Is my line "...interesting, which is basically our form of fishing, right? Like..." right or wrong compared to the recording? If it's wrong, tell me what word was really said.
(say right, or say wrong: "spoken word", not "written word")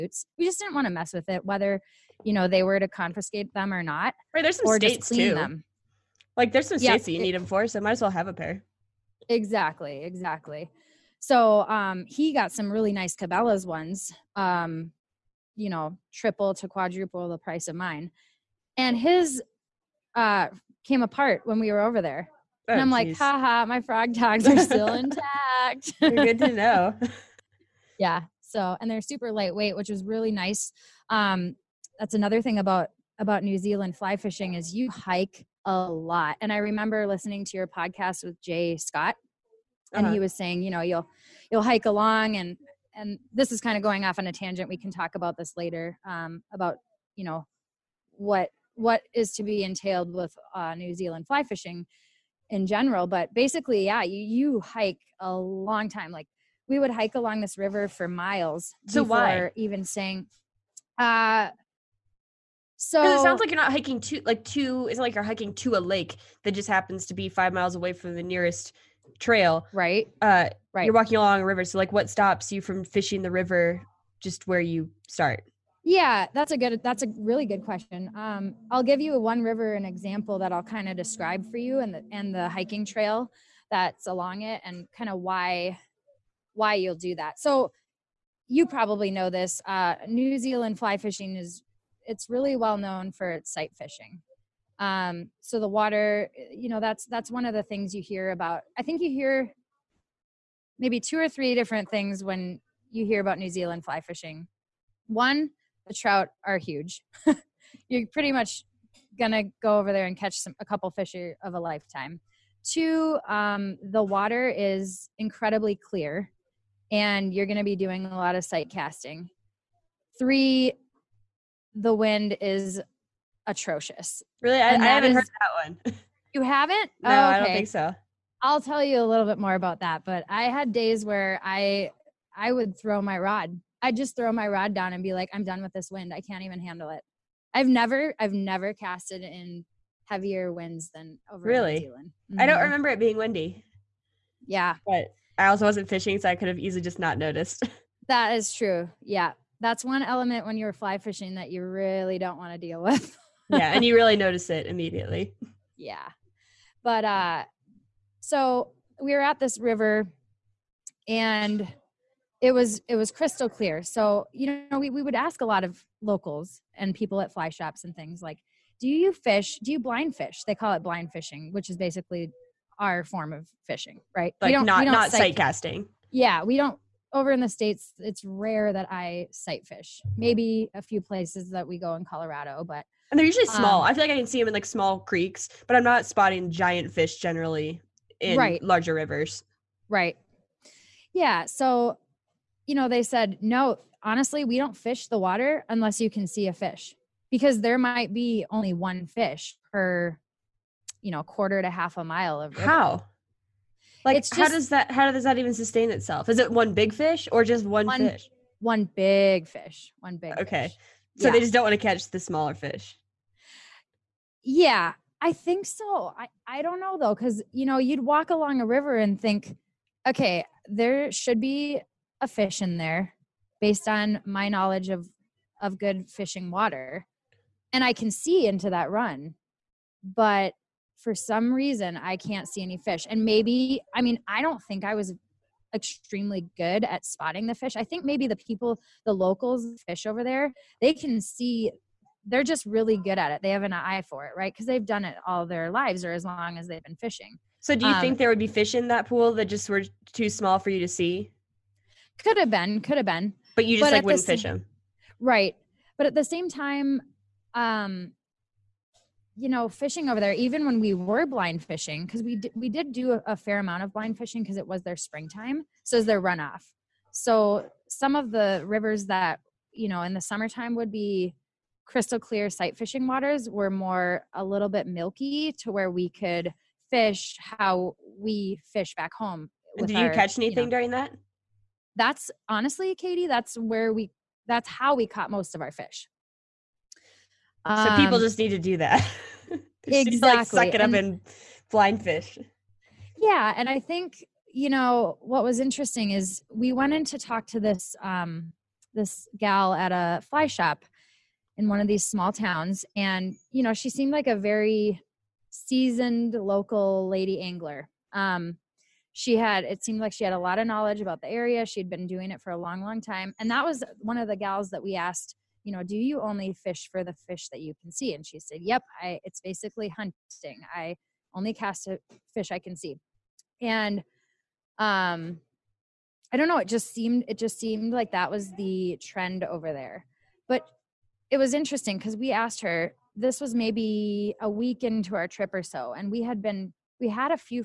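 wrong: "fishing", not "interesting".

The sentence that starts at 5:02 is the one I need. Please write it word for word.
And, you know, she seemed like a very seasoned local lady angler.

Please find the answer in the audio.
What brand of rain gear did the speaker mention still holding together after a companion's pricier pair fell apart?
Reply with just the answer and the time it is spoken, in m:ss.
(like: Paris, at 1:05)
Frog Togs, at 0:23.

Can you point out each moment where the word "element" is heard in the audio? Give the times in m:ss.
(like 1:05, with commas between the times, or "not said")
2:30.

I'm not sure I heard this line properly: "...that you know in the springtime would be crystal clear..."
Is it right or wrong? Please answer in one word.
wrong.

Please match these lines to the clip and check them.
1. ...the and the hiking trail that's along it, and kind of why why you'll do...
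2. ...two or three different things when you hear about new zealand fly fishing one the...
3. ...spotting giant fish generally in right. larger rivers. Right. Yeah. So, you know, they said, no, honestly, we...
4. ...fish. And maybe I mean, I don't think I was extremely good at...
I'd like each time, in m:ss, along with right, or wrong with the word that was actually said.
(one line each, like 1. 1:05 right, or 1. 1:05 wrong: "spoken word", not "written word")
1. 1:21 right
2. 1:40 right
3. 3:06 right
4. 3:52 right.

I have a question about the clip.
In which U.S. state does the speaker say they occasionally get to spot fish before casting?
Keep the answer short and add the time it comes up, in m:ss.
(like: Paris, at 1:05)
Colorado, at 3:02.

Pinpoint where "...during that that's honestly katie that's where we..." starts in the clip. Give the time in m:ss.
4:40.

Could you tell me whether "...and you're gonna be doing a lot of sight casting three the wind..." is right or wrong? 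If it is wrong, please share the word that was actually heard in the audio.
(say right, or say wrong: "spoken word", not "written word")
right.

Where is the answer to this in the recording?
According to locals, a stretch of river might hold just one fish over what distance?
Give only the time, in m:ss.
3:21.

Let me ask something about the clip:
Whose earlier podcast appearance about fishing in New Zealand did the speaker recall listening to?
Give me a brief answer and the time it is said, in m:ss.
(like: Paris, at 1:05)
Jay Scott, at 0:38.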